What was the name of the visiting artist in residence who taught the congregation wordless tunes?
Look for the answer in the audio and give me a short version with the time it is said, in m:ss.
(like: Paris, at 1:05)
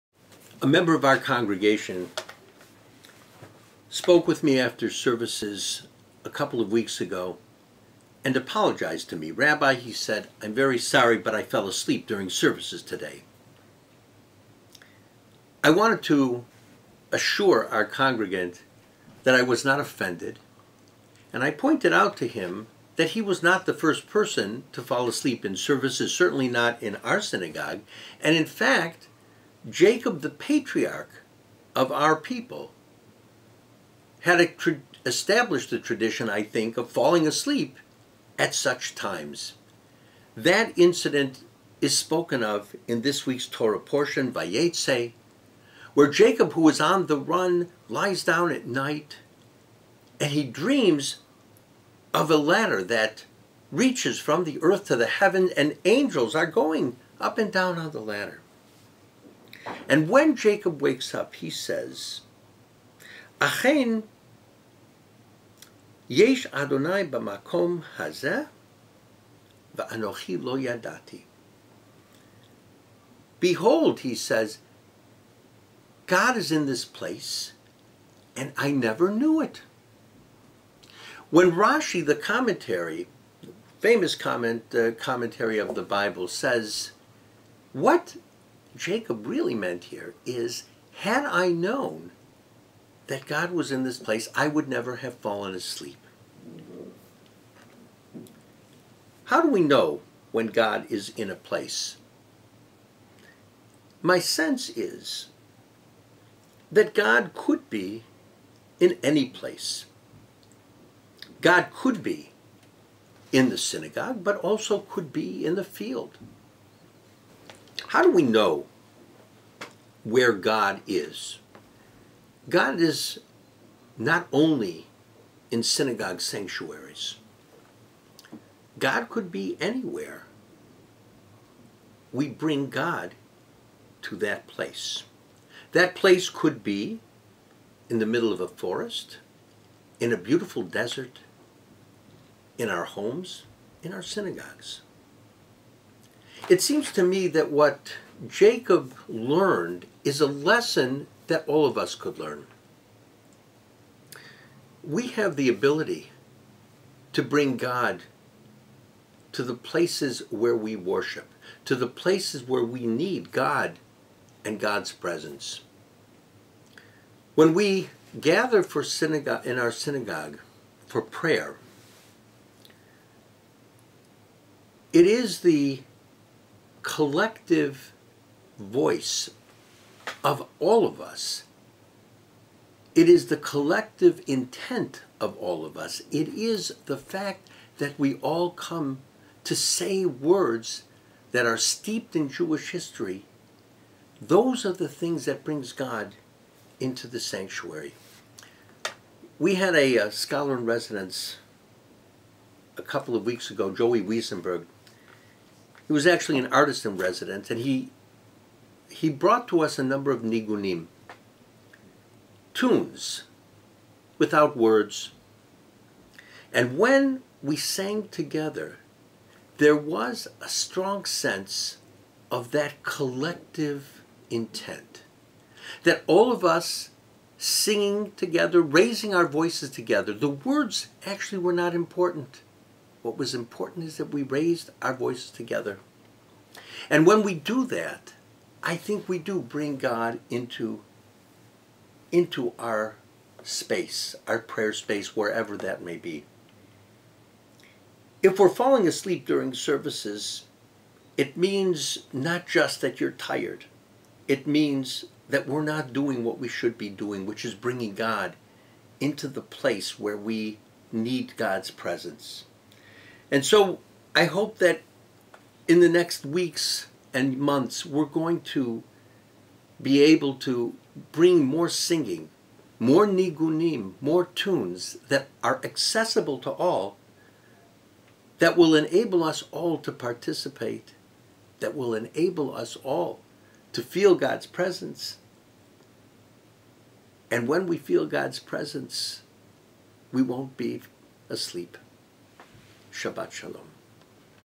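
Joey Weisenberg, at 3:23.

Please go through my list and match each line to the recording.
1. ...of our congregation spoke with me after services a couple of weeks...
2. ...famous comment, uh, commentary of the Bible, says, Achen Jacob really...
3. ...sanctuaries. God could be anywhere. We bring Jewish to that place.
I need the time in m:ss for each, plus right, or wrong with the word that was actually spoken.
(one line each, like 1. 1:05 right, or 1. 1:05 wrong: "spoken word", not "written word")
1. 0:00 right
2. 1:23 wrong: "What", not "Achen"
3. 2:06 wrong: "God", not "Jewish".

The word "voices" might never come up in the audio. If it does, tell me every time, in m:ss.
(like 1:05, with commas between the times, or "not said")
2:58, 3:49, 3:54.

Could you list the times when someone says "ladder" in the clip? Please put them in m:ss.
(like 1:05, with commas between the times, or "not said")
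0:52, 0:57.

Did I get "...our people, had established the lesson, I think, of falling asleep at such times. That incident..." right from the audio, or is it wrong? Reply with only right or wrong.
wrong.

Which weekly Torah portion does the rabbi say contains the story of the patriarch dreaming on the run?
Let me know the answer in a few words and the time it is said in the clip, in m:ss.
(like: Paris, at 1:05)
Vayetzi, at 0:44.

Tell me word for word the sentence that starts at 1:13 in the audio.
Behold, he says, God is in this place, and I never knew it.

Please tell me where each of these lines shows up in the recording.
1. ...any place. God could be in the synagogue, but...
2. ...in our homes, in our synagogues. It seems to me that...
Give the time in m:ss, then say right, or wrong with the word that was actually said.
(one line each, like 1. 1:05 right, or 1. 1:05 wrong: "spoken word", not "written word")
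1. 1:49 right
2. 2:22 right.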